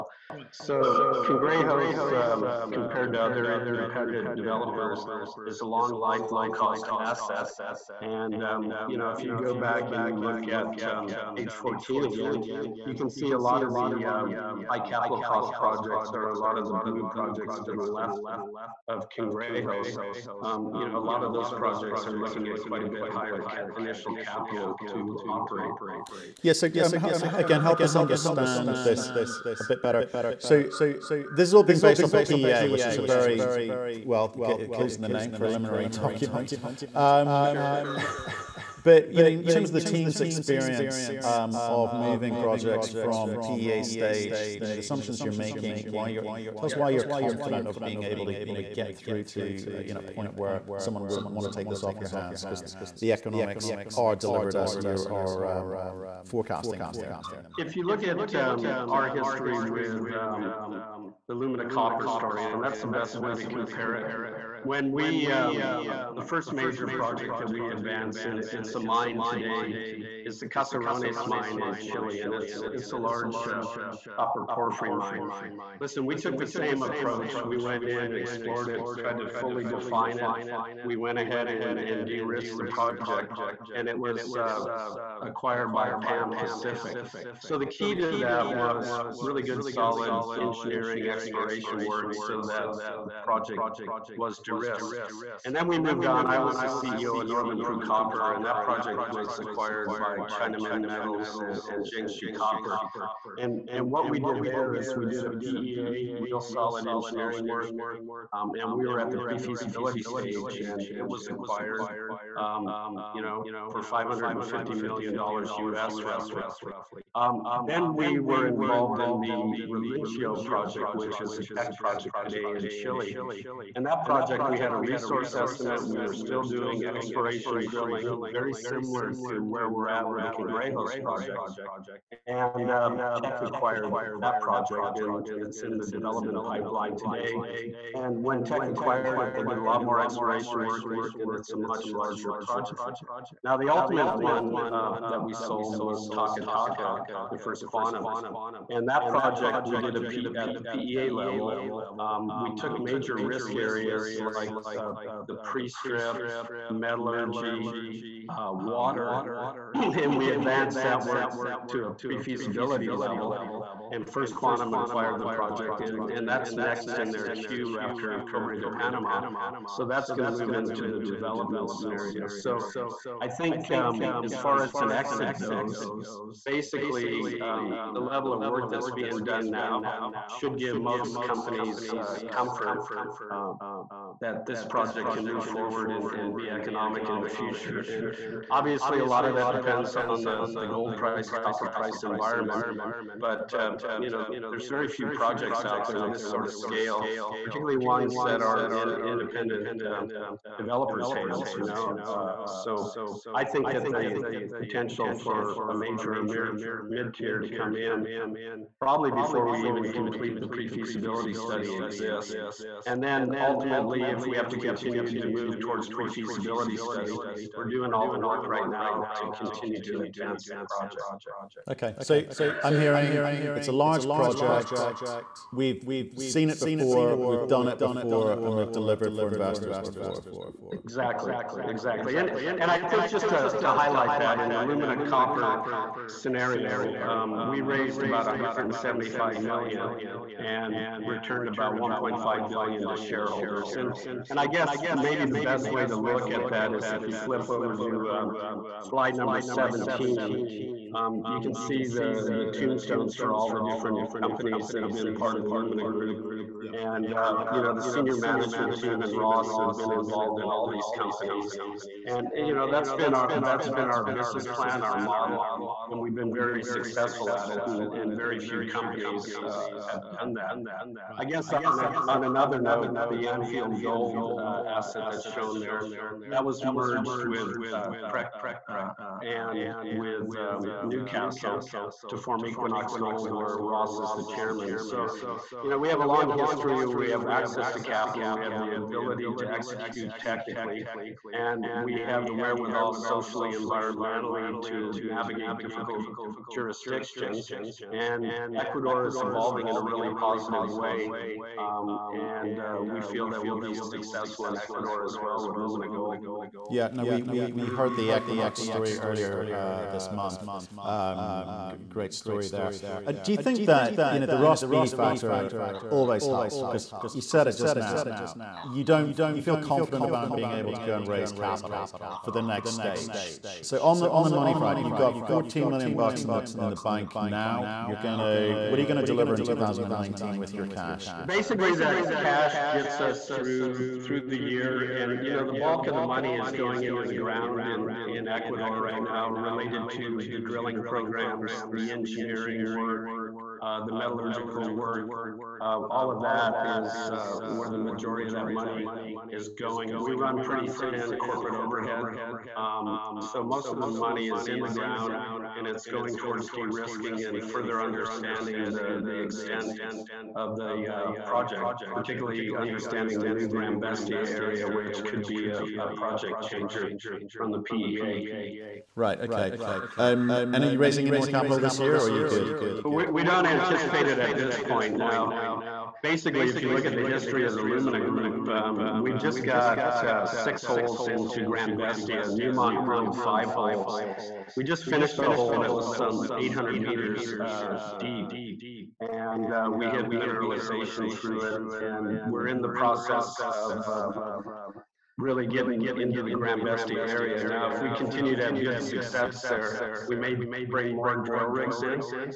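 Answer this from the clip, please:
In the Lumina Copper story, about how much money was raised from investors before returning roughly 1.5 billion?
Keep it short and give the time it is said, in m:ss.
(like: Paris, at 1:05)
175 million, at 3:58.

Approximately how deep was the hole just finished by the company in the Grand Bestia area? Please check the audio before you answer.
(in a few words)
800 meters.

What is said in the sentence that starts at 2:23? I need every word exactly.
Now, the ultimate one uh, that we sold was Taca Taca, the first quantum.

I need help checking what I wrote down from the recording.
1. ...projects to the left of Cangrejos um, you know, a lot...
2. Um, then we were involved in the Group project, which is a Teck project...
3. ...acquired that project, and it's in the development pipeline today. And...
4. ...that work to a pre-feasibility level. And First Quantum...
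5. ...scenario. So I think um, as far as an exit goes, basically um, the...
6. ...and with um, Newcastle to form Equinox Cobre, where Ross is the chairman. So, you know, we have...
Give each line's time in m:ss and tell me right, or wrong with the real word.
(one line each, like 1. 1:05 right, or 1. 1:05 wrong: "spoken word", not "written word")
1. 0:17 right
2. 1:57 wrong: "Relincho", not "Group"
3. 2:13 right
4. 2:40 right
5. 2:51 right
6. 4:39 wrong: "Gold", not "Cobre".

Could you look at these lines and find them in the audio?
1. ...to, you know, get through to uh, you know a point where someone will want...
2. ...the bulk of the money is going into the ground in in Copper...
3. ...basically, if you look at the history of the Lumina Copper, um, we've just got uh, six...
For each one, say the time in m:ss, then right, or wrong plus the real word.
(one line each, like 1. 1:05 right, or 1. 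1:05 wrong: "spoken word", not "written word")
1. 0:48 right
2. 5:35 wrong: "Ecuador", not "Copper"
3. 6:16 wrong: "Group", not "Copper".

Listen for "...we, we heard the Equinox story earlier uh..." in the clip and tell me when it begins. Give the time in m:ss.
5:07.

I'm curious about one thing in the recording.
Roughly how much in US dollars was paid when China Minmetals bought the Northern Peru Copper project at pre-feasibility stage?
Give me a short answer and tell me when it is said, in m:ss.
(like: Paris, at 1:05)
$550 million, at 1:53.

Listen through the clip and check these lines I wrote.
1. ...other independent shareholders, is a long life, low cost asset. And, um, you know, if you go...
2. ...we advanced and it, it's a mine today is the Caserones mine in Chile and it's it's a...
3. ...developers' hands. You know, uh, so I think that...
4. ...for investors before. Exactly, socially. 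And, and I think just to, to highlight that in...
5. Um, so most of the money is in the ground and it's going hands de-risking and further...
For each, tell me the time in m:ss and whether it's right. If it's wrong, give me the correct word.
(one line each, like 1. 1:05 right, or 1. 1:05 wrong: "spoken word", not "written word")
1. 0:03 wrong: "developers", not "shareholders"
2. 1:07 right
3. 3:20 right
4. 3:49 wrong: "exactly", not "socially"
5. 5:52 wrong: "towards", not "hands".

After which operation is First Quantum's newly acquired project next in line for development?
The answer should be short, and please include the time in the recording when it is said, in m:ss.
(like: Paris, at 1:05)
Cobre de Panama, at 2:48.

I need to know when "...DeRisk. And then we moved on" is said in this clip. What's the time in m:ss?
1:34.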